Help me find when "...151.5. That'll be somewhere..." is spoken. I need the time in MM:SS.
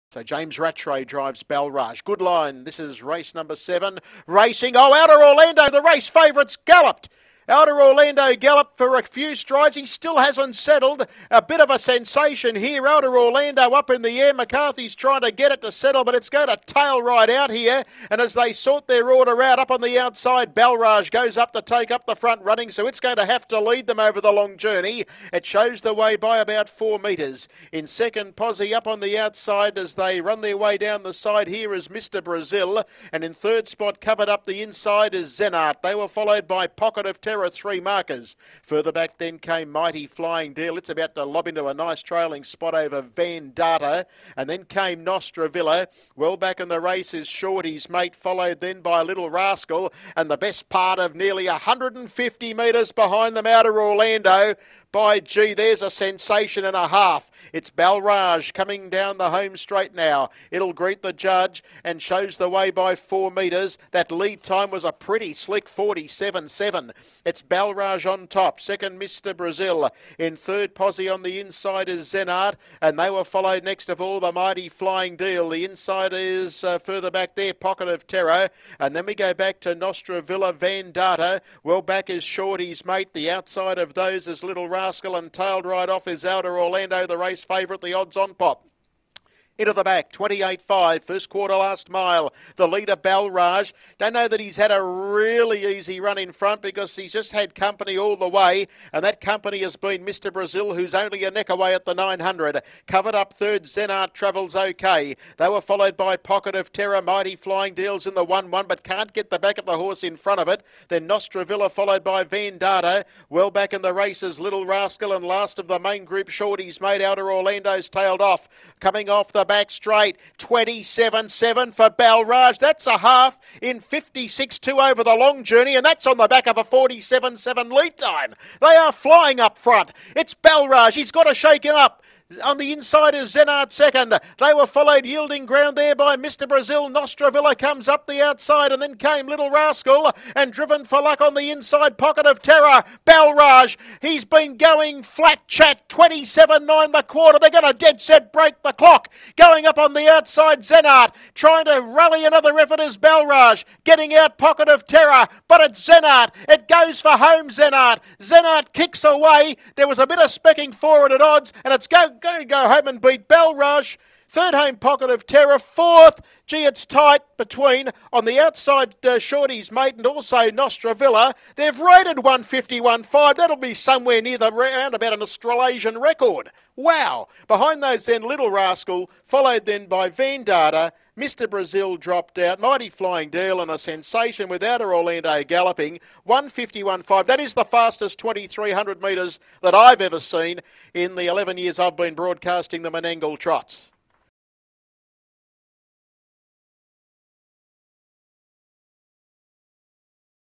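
02:52.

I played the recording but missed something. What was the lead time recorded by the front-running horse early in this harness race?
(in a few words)
47.7.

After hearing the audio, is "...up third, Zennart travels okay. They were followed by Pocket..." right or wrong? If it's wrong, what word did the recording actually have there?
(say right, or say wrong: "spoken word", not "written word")
right.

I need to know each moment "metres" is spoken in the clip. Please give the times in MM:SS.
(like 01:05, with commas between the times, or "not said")
00:26, 00:52, 01:03, 03:09.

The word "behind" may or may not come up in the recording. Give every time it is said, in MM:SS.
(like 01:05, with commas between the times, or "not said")
00:52, 02:57.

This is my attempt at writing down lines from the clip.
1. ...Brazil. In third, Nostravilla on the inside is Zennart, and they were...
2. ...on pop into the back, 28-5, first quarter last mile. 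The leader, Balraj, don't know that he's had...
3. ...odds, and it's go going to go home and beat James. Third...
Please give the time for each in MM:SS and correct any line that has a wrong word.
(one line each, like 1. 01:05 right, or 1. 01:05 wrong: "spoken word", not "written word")
1. 01:09 wrong: "Posse", not "Nostravilla"
2. 01:28 right
3. 02:41 wrong: "Rush", not "James".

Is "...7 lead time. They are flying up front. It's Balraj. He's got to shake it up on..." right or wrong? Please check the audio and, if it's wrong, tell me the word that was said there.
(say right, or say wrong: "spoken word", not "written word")
right.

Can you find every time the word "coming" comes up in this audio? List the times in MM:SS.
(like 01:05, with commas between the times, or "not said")
00:58, 01:58.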